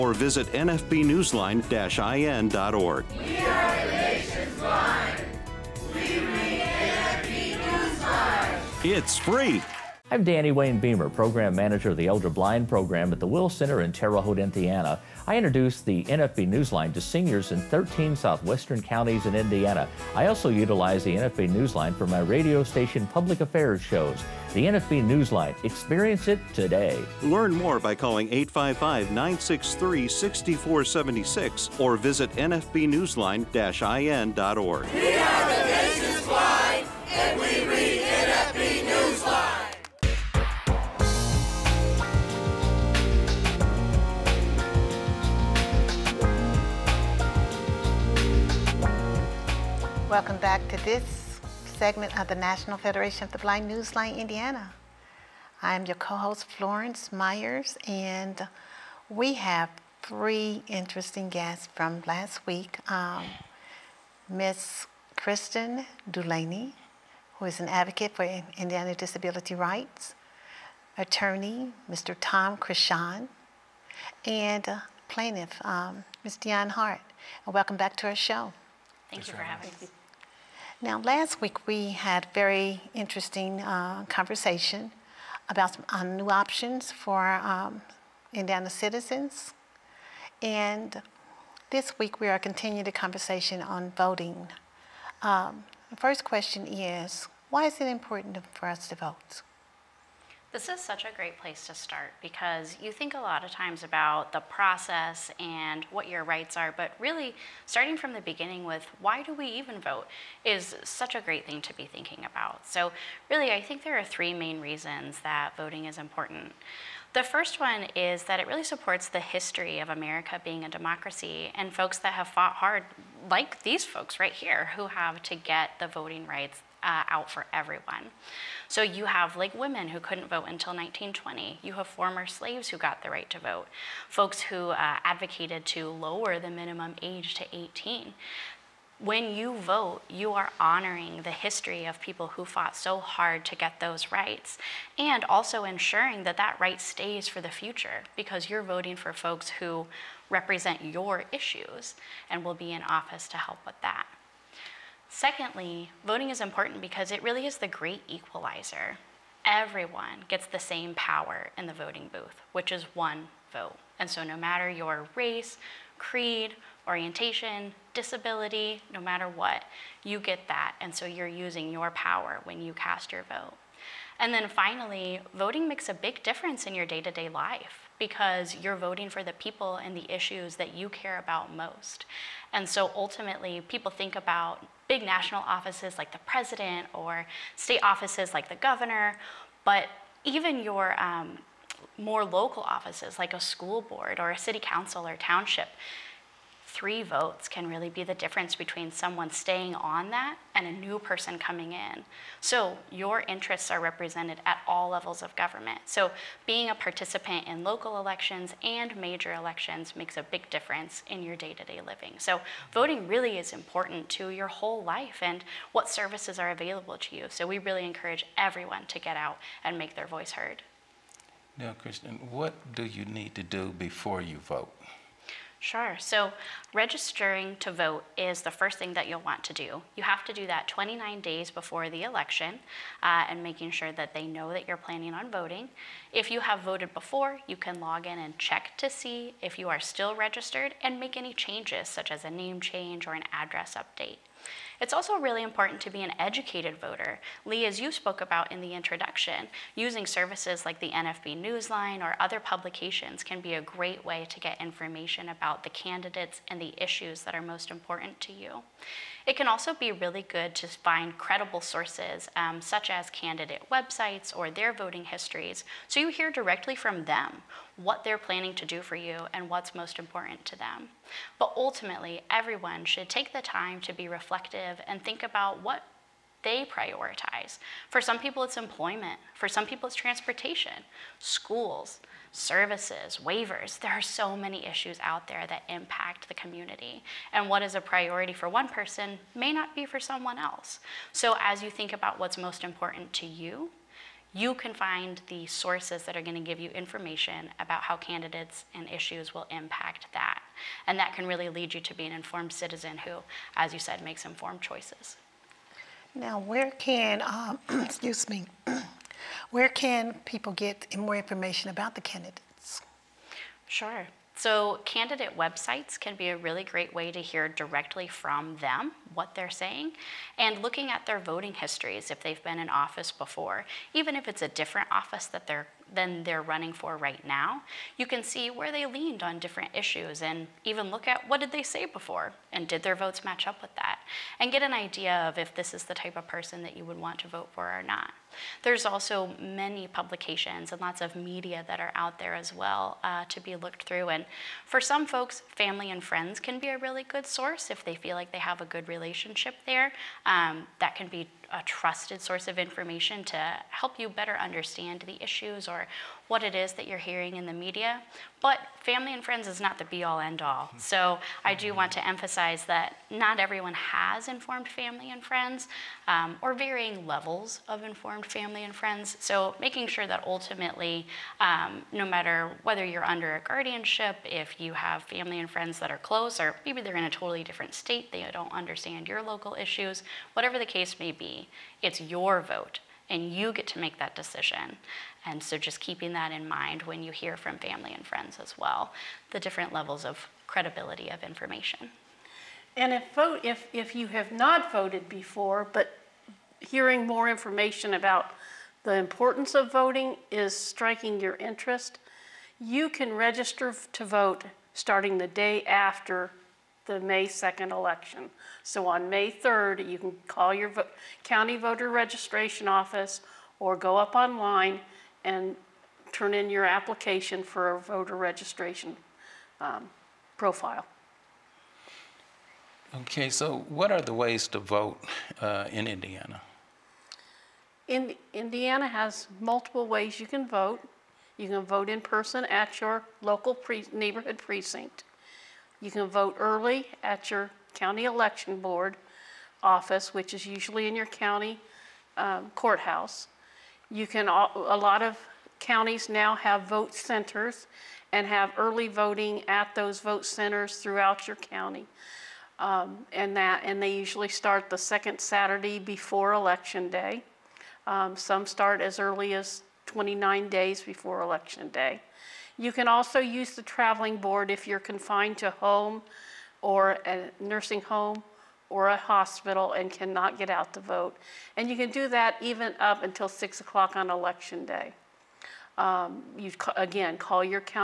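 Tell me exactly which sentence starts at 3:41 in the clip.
Now, Kristen, what do you need to do before you vote?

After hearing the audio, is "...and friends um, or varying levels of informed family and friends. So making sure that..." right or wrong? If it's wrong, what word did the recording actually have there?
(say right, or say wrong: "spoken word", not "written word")
right.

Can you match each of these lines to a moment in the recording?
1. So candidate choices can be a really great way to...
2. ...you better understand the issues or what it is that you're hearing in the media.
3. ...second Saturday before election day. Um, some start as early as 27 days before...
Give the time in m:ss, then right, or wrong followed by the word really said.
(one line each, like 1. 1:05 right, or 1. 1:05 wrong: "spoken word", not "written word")
1. 5:14 wrong: "websites", not "choices"
2. 5:53 right
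3. 7:34 wrong: "29", not "27".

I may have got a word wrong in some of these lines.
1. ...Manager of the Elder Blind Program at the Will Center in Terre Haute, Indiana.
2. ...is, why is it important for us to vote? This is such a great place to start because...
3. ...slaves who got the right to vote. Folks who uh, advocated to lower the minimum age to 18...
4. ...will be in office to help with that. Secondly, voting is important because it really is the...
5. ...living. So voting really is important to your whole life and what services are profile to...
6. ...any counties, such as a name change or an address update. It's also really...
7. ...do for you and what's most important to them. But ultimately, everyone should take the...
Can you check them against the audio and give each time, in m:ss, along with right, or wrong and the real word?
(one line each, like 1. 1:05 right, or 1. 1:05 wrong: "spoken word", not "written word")
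1. 0:11 right
2. 1:36 right
3. 2:12 right
4. 2:32 right
5. 3:31 wrong: "available", not "profile"
6. 4:01 wrong: "changes", not "counties"
7. 4:28 right.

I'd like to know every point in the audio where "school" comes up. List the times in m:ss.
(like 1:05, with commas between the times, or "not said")
3:13, 4:41.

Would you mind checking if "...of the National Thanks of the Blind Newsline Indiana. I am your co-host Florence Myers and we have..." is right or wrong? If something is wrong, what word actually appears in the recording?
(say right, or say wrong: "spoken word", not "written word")
wrong: "Federation", not "Thanks".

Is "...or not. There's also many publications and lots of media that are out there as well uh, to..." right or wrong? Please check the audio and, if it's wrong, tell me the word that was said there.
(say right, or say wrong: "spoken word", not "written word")
right.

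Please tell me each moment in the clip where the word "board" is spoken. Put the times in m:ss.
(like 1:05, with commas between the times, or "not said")
3:13, 7:18, 7:44.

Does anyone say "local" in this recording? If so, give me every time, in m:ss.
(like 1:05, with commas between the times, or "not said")
3:12, 3:27, 6:19, 7:13.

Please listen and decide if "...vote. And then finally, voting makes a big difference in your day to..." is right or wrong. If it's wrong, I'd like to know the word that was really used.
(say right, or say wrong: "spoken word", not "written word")
right.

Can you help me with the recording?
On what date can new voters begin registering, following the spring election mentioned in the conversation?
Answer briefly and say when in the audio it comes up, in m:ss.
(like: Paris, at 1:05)
May 3rd, at 6:49.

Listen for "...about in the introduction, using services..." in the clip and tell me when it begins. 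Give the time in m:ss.
4:08.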